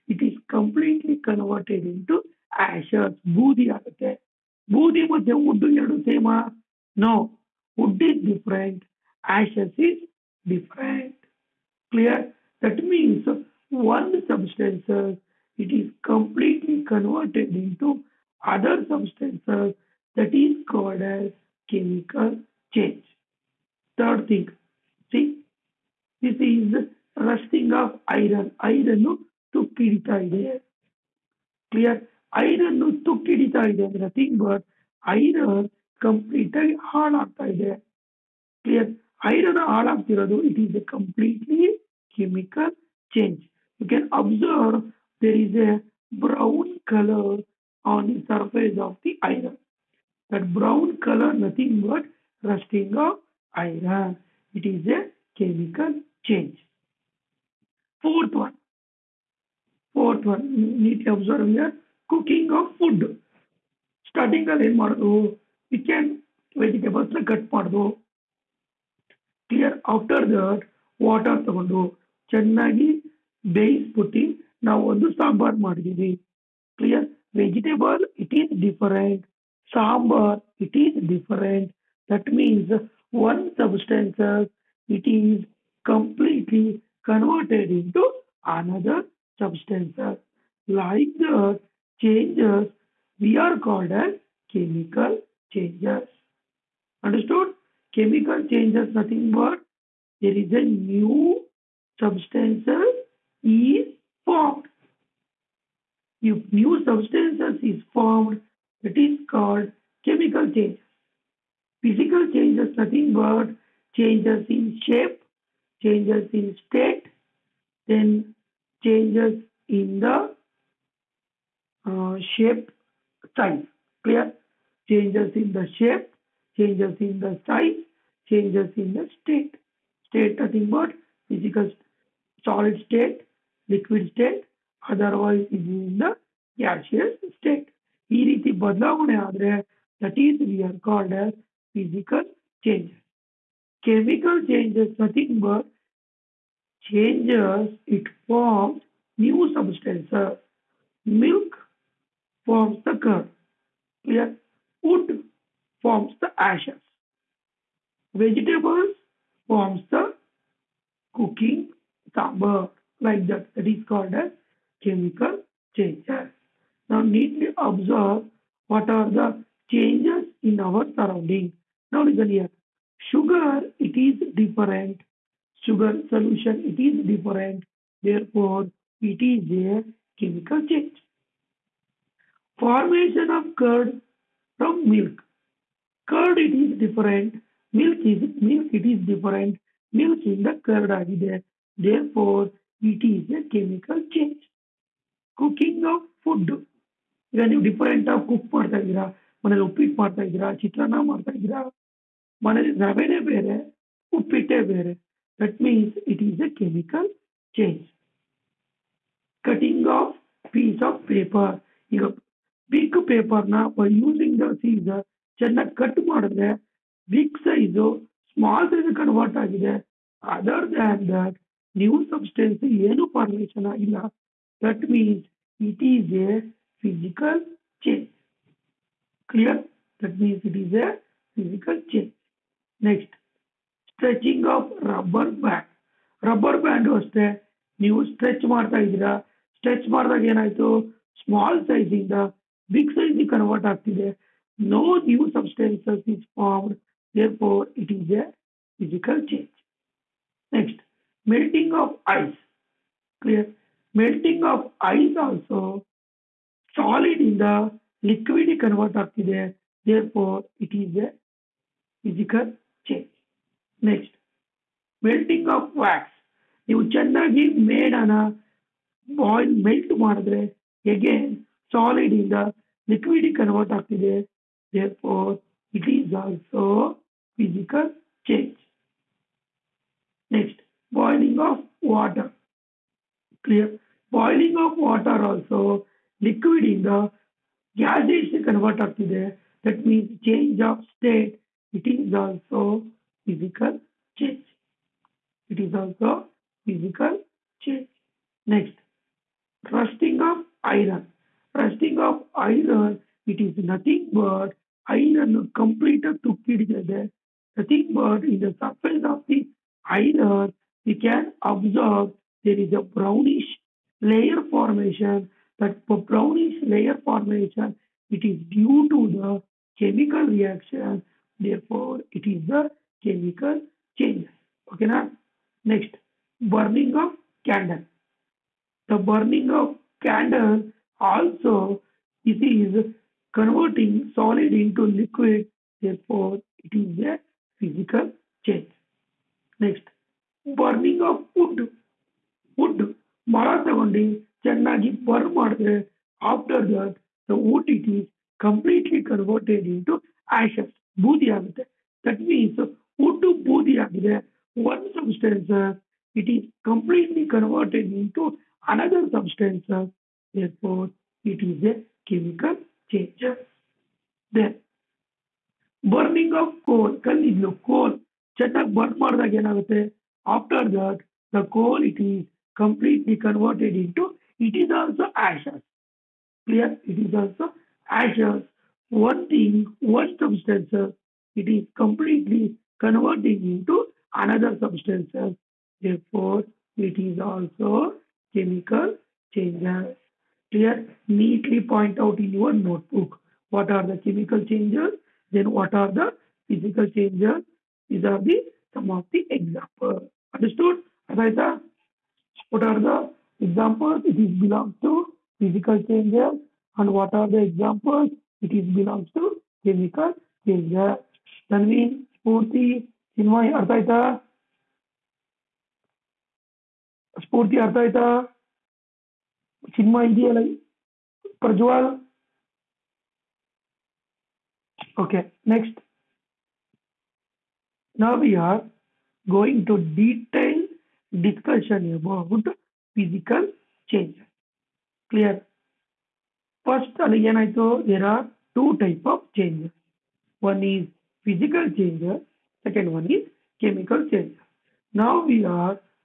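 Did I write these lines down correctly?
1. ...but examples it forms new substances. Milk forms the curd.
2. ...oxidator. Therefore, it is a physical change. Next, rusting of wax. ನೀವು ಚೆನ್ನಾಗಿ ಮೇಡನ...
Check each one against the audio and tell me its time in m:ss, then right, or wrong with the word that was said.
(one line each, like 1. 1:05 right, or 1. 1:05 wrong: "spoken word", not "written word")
1. 2:25 wrong: "changes", not "examples"
2. 4:18 wrong: "melting", not "rusting".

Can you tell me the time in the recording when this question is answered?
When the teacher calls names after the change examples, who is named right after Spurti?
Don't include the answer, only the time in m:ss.
6:53.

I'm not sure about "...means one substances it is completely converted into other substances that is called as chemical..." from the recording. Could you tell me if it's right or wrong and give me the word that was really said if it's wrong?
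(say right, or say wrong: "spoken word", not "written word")
right.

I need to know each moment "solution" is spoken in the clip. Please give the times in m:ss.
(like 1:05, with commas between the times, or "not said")
2:56.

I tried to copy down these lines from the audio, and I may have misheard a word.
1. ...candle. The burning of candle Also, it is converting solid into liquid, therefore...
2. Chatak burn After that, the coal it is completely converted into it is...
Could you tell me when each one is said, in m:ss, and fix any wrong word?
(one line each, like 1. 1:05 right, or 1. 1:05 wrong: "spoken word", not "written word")
1. 5:27 right
2. 6:08 right.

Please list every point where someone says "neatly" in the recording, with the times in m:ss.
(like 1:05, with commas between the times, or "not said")
1:00, 2:47, 6:31.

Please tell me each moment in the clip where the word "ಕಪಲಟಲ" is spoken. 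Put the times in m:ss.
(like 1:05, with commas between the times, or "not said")
0:00, 0:40, 1:25, 5:48, 5:56.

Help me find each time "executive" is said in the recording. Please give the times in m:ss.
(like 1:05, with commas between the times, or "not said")
not said.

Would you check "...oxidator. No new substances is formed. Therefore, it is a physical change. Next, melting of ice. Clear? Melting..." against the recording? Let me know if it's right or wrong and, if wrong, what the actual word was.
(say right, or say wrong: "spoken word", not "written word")
right.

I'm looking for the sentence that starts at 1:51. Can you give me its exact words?
Physical changes nothing but changes in shape, changes in state, then changes in the uh, shape size.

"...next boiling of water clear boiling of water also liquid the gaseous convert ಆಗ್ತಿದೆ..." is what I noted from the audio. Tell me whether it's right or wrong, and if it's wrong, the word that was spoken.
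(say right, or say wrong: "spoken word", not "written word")
right.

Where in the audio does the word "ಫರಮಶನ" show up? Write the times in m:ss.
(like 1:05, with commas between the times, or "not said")
3:43.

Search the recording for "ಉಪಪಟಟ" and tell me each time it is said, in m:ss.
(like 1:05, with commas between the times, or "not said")
3:19, 3:24.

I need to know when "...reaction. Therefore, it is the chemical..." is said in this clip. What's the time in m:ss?
5:20.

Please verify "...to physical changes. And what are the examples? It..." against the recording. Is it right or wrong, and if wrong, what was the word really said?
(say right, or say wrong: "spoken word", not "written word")
right.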